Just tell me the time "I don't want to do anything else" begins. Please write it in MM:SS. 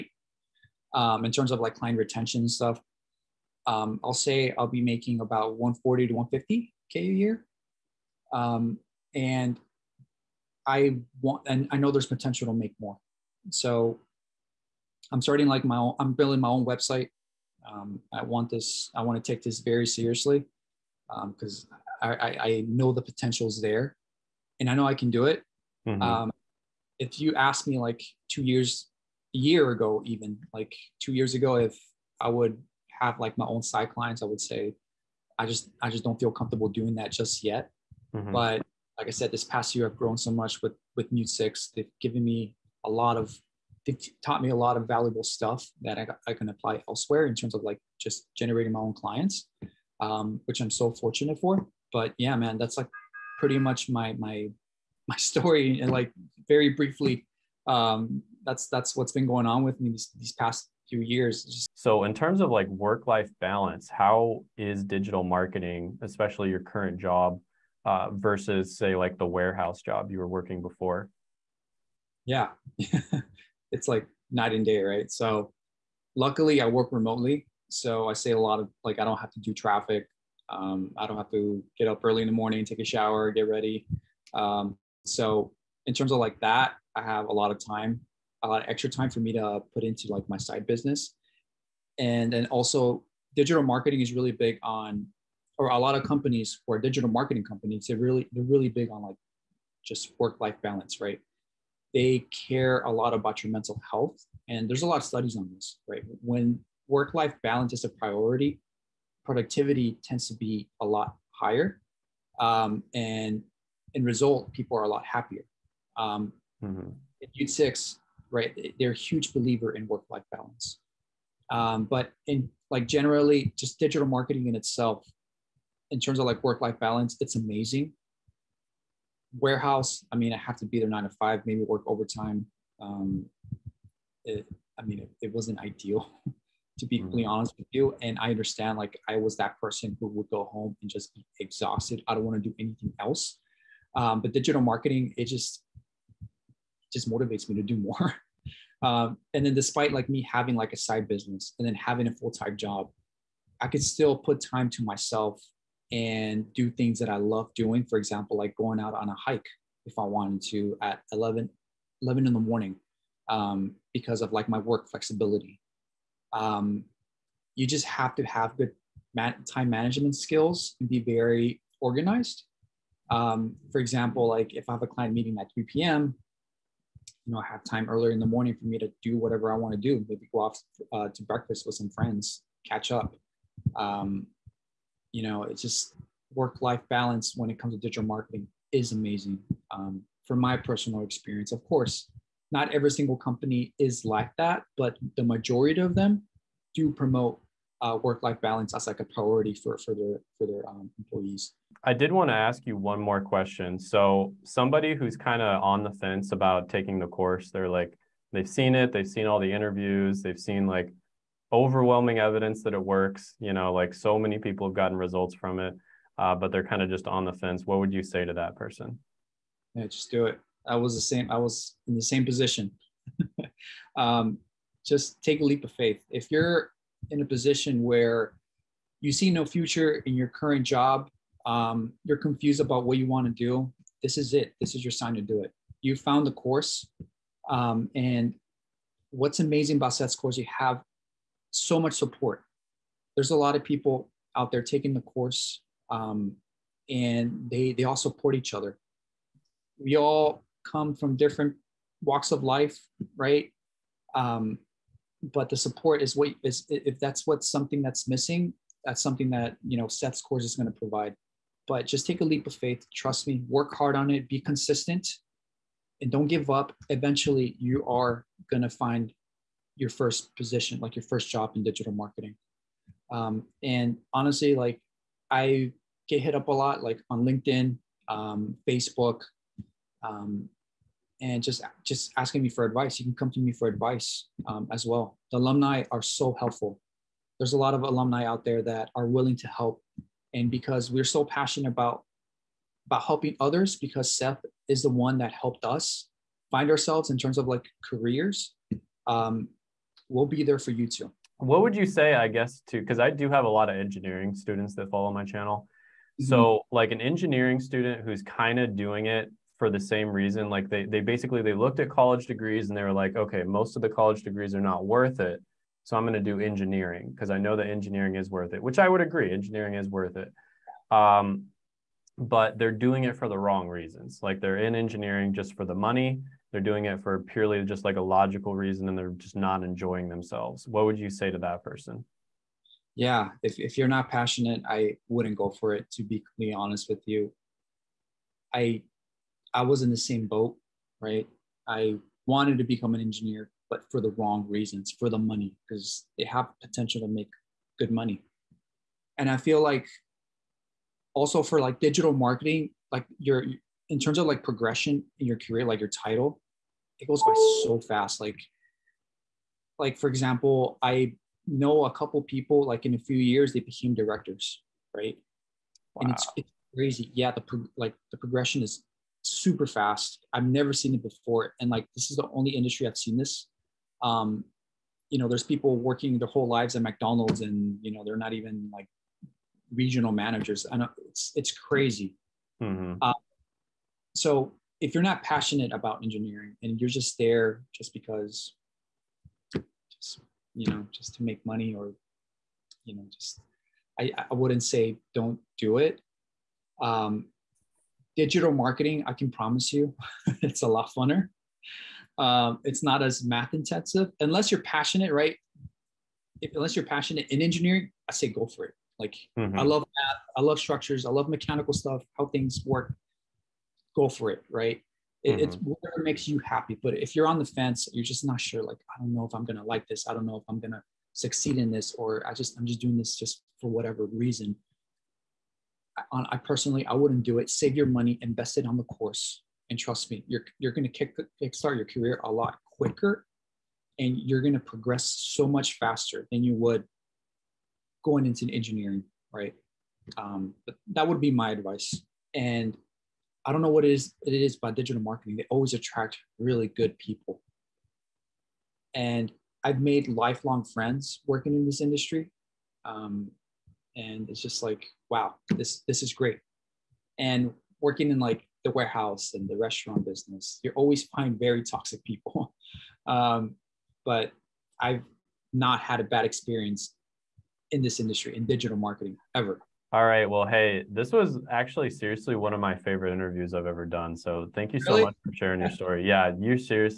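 02:22.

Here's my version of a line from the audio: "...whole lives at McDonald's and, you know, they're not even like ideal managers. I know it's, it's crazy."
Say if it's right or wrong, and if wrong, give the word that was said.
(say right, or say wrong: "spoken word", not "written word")
wrong: "regional", not "ideal".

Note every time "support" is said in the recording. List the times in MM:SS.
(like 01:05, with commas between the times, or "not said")
04:01, 04:07, 04:15.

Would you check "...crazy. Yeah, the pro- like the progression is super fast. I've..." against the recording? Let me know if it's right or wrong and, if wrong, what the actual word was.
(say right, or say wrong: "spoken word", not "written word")
right.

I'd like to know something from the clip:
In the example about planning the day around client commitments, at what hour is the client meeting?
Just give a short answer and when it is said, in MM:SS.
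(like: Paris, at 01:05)
3 p.m., at 02:55.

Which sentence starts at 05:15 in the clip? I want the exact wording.
So I'm going to do engineering because I know that engineering is worth it, which I would agree.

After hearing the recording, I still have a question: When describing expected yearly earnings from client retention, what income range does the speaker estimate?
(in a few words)
140 to 150k.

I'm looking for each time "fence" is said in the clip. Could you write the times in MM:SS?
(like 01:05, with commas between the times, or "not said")
03:25, 03:37, 06:57.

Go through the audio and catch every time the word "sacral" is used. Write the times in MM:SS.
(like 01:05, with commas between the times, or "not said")
not said.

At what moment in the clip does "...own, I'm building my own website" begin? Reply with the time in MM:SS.
00:15.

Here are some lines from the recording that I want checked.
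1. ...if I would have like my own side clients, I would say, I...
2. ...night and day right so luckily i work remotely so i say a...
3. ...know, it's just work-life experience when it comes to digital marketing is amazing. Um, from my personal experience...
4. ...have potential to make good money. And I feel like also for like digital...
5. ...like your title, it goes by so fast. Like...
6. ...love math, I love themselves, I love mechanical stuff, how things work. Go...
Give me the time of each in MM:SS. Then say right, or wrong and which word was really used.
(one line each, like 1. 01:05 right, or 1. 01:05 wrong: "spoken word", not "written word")
1. 00:31 right
2. 01:14 right
3. 03:05 wrong: "balance", not "experience"
4. 05:46 right
5. 05:55 right
6. 06:49 wrong: "structures", not "themselves".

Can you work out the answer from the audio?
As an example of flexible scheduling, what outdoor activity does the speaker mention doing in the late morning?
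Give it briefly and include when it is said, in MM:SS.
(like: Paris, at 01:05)
Hike, at 02:39.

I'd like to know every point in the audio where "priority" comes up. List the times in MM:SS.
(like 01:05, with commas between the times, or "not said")
01:47, 03:19.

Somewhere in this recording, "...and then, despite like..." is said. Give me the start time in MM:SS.
02:29.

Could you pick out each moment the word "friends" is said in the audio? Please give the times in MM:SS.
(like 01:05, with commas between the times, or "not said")
03:01, 07:30.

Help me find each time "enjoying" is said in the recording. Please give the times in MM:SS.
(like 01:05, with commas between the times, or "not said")
05:29.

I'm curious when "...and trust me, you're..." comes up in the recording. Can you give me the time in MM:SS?
07:09.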